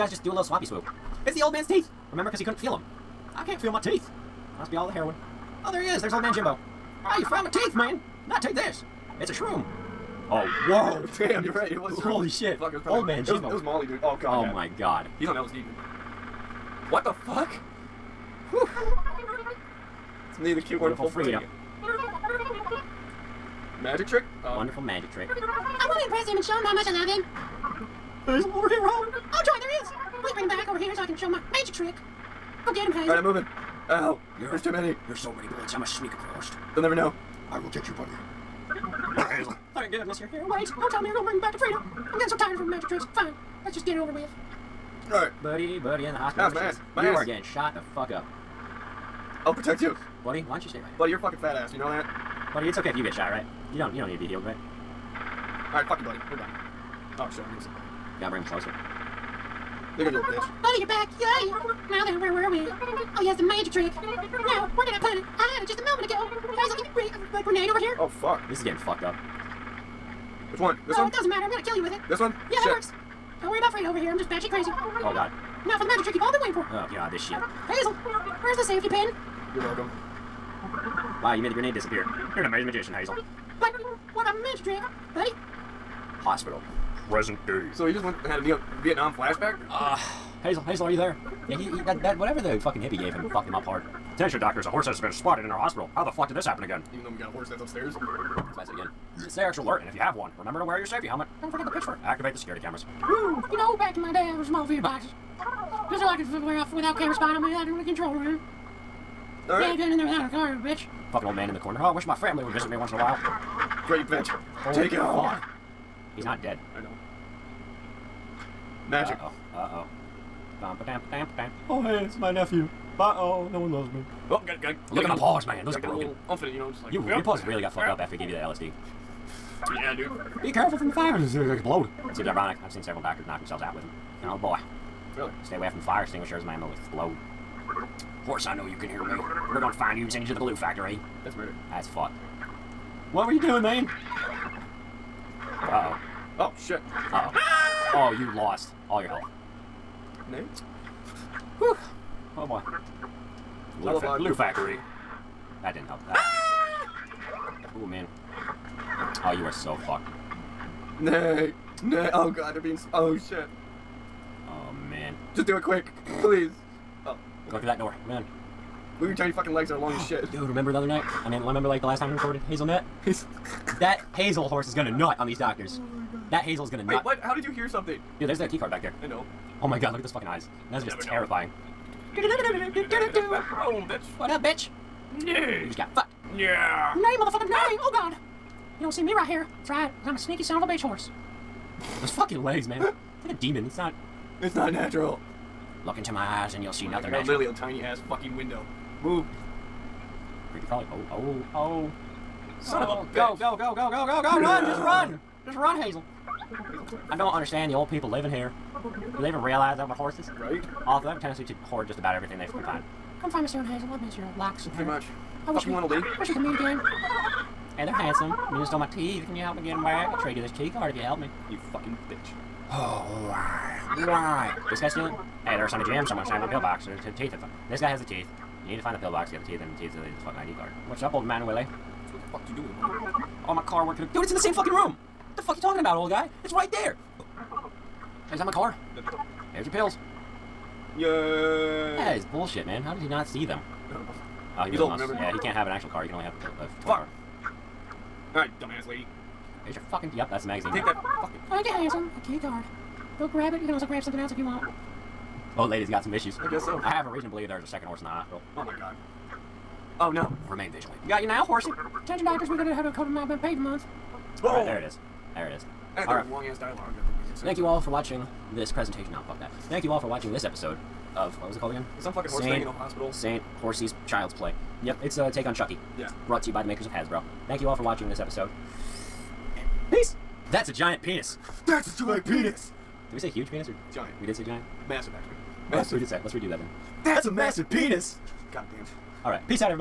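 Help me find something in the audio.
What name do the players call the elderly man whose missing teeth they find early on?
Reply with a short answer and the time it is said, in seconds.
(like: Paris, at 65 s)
Jimbo, at 6 s.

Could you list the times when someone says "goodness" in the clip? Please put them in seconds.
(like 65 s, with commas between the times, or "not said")
39 s.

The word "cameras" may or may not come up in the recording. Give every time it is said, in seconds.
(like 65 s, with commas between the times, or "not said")
102 s, 106 s.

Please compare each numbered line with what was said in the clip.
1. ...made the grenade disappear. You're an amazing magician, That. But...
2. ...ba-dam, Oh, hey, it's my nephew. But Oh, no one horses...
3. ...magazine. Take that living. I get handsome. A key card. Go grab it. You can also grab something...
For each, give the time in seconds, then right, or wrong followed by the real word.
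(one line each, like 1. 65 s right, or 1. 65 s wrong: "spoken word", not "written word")
1. 81 s wrong: "Hazel", not "That"
2. 121 s wrong: "loves", not "horses"
3. 250 s wrong: "fucking", not "living".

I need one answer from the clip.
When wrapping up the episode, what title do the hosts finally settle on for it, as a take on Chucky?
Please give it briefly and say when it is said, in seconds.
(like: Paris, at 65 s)
Saint Horsey's Child's Play, at 273 s.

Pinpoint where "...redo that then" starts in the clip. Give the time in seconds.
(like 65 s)
286 s.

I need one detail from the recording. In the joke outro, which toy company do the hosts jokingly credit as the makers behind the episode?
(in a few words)
Hasbro.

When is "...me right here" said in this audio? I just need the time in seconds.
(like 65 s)
189 s.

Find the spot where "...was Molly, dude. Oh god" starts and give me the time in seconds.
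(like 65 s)
13 s.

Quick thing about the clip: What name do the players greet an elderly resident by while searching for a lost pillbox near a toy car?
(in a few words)
Willie.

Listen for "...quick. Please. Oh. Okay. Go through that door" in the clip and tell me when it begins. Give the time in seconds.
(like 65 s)
165 s.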